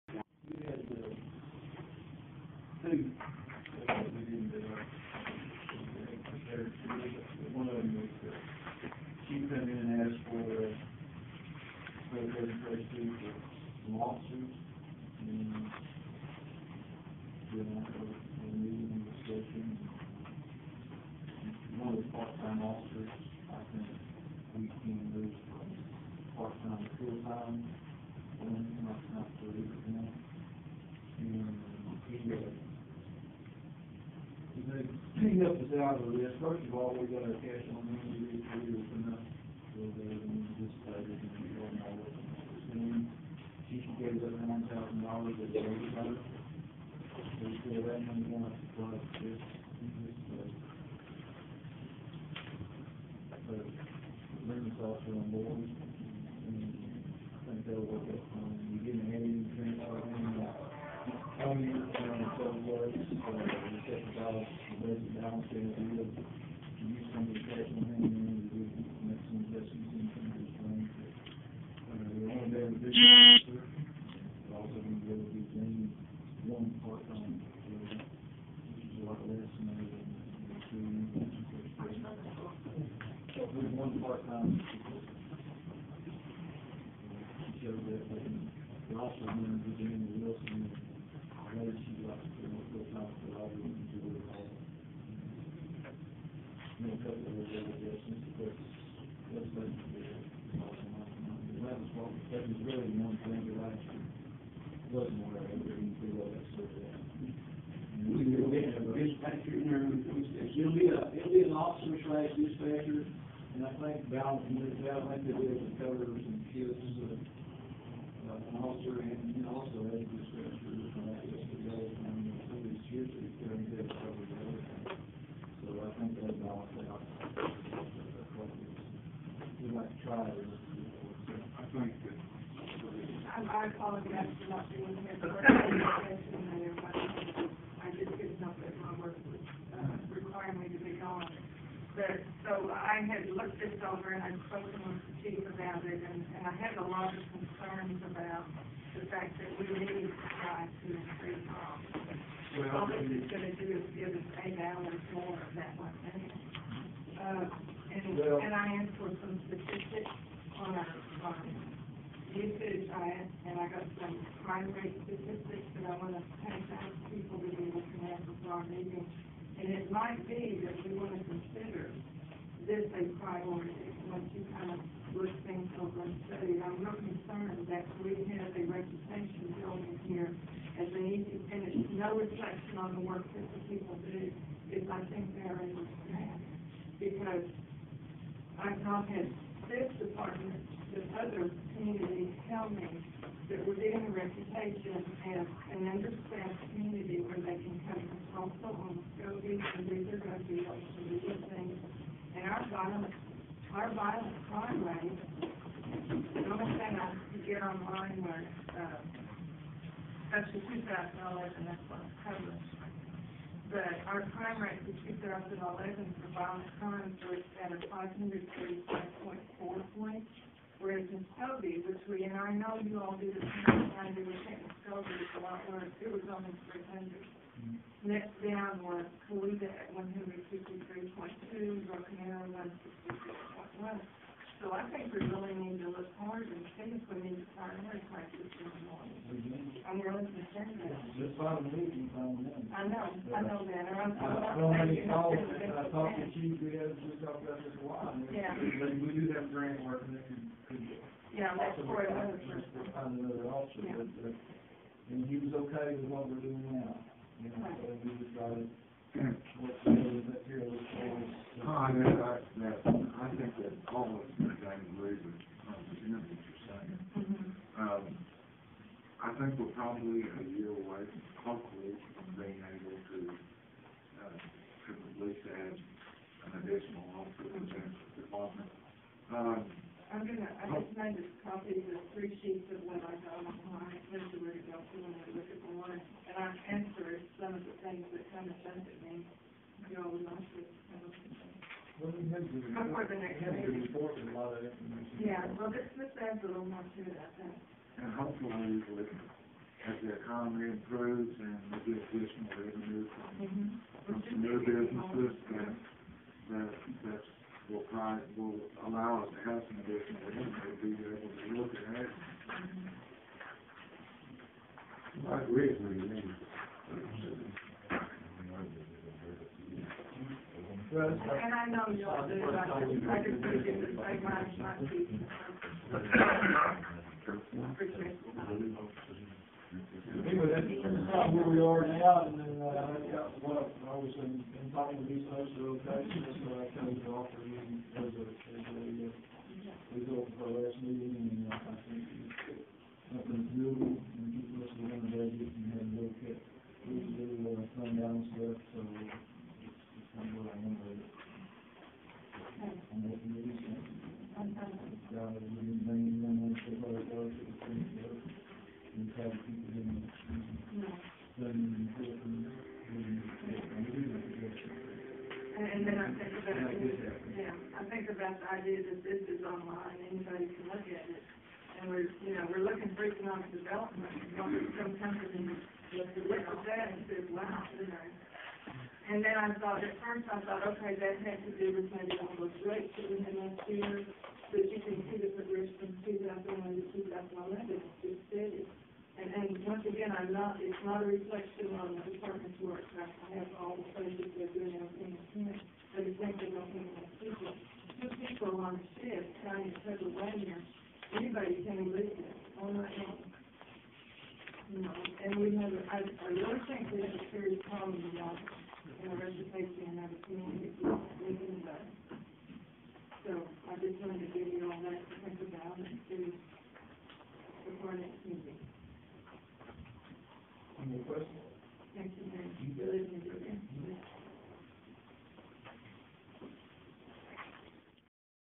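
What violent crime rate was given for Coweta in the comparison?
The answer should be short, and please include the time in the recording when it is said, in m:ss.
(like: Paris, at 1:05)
153.2, at 3:49.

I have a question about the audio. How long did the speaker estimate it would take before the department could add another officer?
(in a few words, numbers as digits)
a year.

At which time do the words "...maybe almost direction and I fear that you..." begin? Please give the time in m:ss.
6:21.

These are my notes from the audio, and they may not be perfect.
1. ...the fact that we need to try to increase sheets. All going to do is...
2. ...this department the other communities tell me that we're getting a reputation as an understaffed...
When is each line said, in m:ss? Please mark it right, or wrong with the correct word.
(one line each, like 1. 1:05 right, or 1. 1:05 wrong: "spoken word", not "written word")
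1. 2:28 wrong: "costs", not "sheets"
2. 3:09 right.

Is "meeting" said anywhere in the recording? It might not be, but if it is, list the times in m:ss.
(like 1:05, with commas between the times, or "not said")
0:18, 2:48, 4:01, 5:40, 6:51.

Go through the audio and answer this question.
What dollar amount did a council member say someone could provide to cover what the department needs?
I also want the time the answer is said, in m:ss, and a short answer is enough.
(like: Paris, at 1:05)
$9,000, at 0:44.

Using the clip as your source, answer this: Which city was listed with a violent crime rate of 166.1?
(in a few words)
Broken Arrow.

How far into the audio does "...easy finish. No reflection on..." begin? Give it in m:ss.
3:01.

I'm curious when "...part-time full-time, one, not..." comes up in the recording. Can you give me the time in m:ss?
0:26.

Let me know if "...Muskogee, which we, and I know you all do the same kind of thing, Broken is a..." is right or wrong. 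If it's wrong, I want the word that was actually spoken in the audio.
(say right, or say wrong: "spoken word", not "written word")
wrong: "Muskogee", not "Broken".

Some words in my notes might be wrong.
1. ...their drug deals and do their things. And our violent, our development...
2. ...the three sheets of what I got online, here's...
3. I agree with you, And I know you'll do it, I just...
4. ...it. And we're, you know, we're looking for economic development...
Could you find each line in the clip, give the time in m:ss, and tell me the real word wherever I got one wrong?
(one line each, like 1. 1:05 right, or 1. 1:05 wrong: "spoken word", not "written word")
1. 3:20 wrong: "violent", not "development"
2. 4:41 right
3. 5:15 right
4. 6:11 right.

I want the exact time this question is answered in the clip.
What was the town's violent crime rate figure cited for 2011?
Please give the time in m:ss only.
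3:37.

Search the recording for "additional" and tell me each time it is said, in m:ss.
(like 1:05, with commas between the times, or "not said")
4:36, 5:02, 5:09.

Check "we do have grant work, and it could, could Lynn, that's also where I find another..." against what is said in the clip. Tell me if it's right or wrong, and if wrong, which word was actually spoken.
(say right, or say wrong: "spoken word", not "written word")
wrong: "Yeah", not "Lynn".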